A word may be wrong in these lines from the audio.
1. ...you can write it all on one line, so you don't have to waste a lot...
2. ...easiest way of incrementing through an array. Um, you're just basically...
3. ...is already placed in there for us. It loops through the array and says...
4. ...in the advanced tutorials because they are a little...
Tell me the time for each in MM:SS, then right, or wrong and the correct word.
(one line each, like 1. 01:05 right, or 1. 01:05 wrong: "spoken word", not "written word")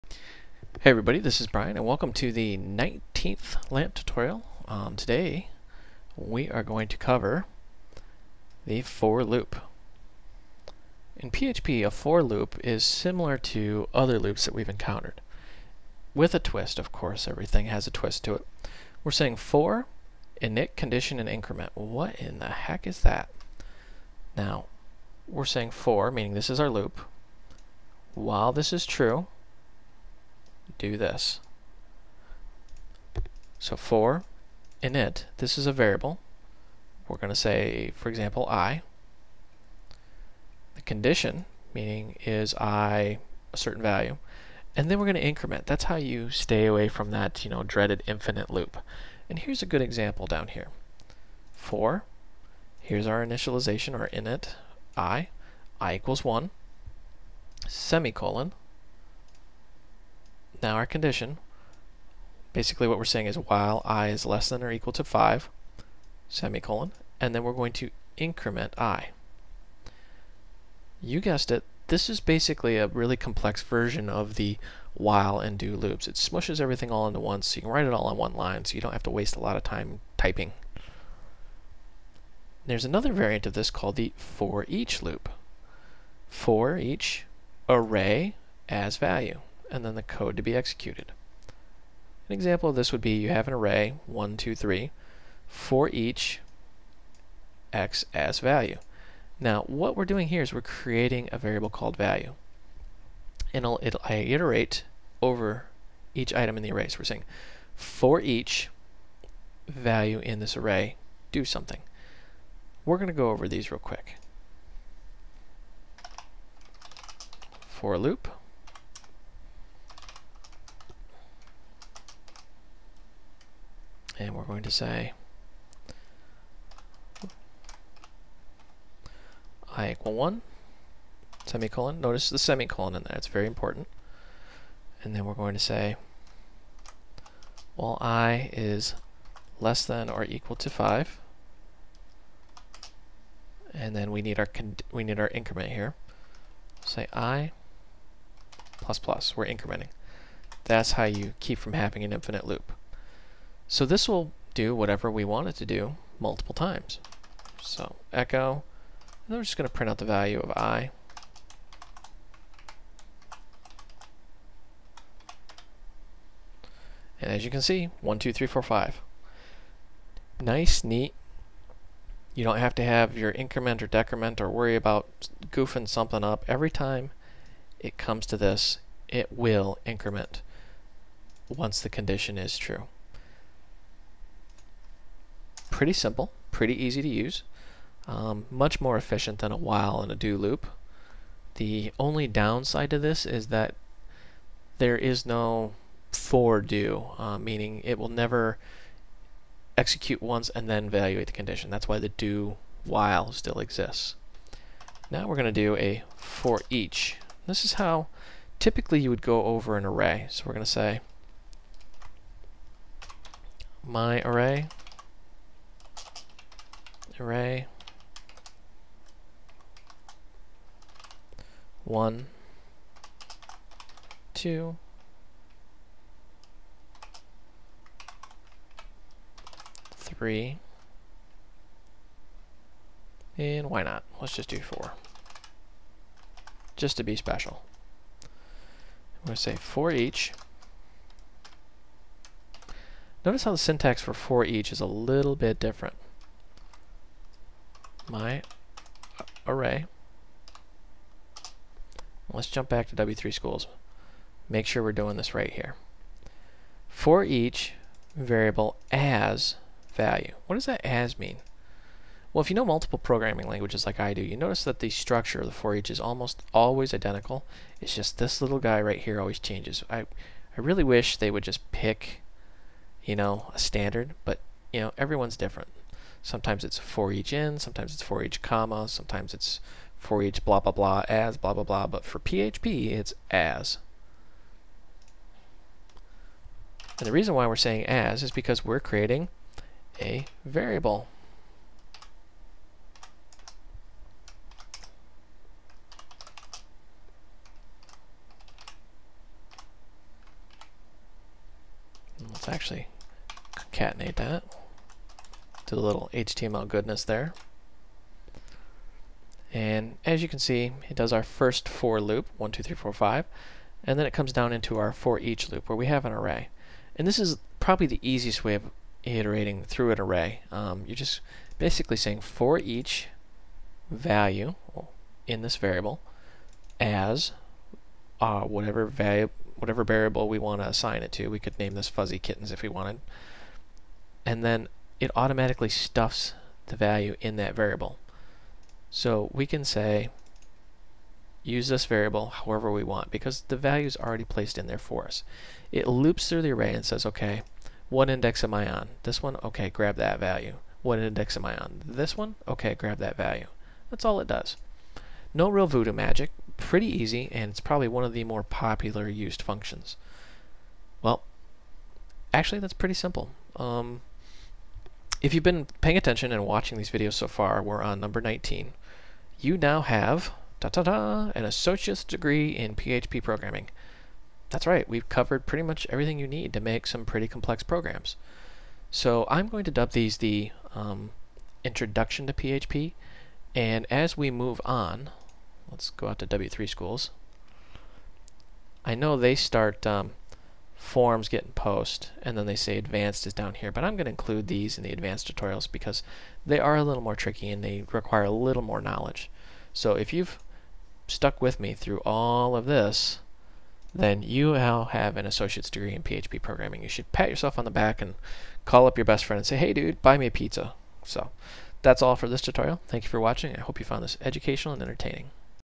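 1. 01:17 right
2. 05:18 wrong: "iterating", not "incrementing"
3. 05:43 right
4. 06:34 right.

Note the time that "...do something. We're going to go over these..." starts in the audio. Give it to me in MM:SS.
01:51.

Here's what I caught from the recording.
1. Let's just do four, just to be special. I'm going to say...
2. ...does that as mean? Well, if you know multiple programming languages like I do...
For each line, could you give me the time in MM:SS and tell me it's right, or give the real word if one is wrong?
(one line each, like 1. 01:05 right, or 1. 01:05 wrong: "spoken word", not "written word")
1. 03:54 right
2. 04:20 right.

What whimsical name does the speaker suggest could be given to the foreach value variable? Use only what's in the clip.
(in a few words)
fuzzy kittens.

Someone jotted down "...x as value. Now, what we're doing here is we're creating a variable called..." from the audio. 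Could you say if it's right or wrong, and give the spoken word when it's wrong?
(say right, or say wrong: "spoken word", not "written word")
right.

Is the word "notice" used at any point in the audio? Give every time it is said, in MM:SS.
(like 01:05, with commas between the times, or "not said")
02:12, 04:03, 04:24.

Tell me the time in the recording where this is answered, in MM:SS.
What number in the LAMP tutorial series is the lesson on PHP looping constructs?
00:02.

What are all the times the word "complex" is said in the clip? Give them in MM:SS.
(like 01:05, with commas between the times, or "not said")
01:13, 06:17.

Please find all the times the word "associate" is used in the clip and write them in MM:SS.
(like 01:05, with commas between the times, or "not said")
06:11, 06:45.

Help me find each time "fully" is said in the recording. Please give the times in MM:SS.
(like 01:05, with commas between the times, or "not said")
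not said.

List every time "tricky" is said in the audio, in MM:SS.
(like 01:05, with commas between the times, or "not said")
06:37.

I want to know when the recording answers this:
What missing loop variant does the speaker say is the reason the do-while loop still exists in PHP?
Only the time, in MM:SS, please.
03:16.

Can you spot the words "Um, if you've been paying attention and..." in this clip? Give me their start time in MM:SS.
06:03.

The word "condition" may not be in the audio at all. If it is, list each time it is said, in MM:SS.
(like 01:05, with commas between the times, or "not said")
00:20, 00:40, 01:00, 03:01, 03:21.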